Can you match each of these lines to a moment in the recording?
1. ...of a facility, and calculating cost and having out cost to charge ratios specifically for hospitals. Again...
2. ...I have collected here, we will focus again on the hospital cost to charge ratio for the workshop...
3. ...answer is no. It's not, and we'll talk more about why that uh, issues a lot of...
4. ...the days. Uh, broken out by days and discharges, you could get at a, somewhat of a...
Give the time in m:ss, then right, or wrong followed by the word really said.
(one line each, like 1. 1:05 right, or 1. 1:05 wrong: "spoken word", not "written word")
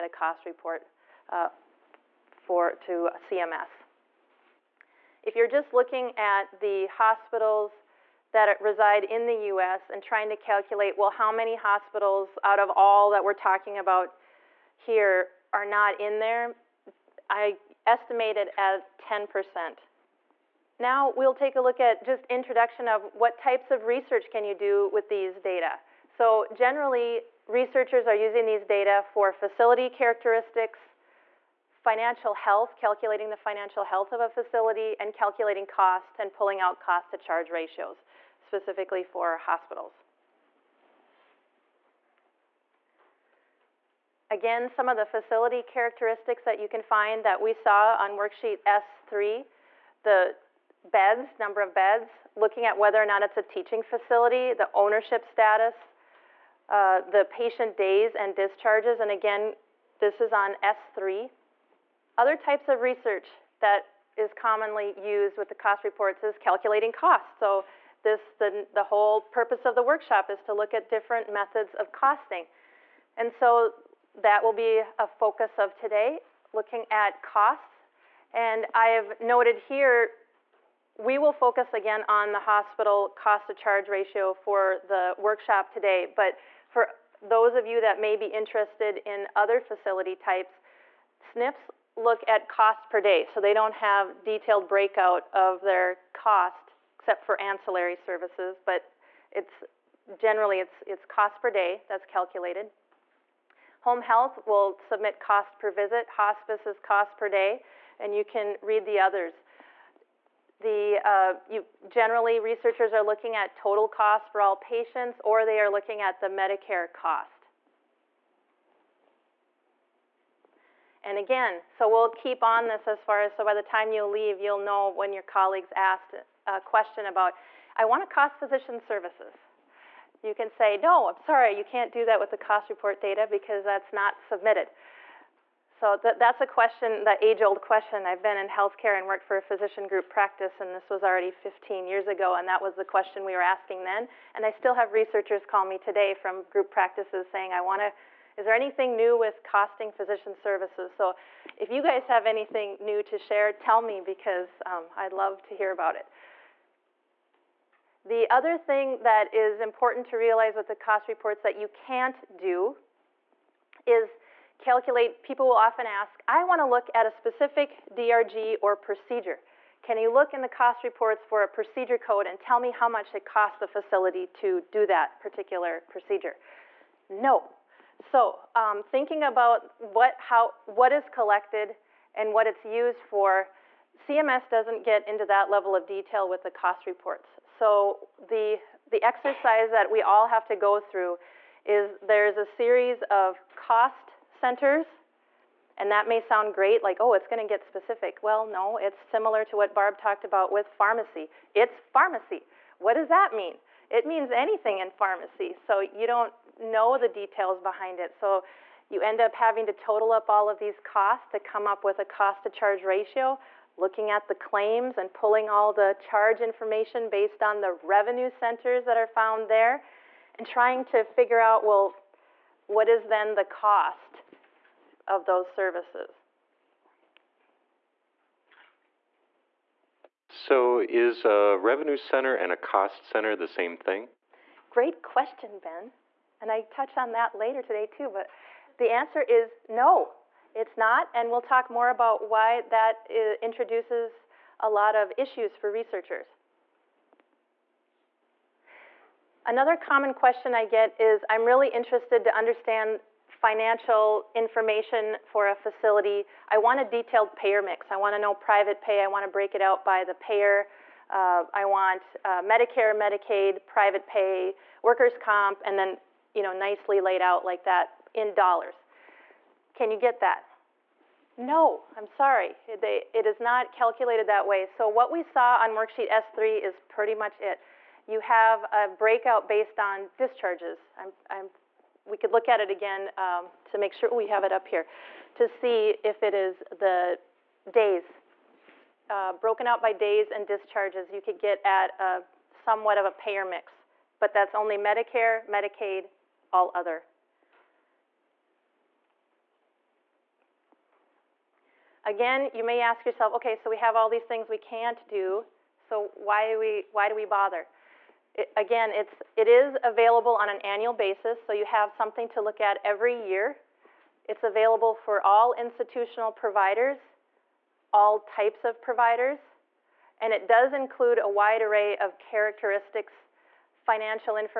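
1. 0:34 wrong: "pulling", not "having"
2. 1:18 wrong: "noted", not "collected"
3. 3:58 wrong: "introduces", not "issues"
4. 4:46 right.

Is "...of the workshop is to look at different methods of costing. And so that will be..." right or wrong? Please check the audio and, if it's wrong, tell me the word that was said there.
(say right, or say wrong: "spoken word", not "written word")
right.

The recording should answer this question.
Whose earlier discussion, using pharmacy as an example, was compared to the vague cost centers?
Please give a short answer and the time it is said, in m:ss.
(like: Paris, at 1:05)
Barb, at 3:19.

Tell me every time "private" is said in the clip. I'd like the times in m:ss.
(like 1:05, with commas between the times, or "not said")
4:18, 4:23.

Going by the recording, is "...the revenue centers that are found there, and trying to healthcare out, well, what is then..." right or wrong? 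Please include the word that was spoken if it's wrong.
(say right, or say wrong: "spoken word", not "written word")
wrong: "figure", not "healthcare".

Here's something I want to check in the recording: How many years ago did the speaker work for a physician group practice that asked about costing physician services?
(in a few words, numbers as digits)
15.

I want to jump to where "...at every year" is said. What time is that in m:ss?
5:12.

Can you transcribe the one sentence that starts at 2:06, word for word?
A question about, I want to cost physician services.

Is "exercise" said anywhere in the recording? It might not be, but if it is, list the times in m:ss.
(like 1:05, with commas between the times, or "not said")
3:09.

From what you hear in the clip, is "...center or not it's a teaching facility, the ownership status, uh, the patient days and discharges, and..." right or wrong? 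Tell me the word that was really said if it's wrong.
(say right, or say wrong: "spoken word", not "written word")
wrong: "whether", not "center".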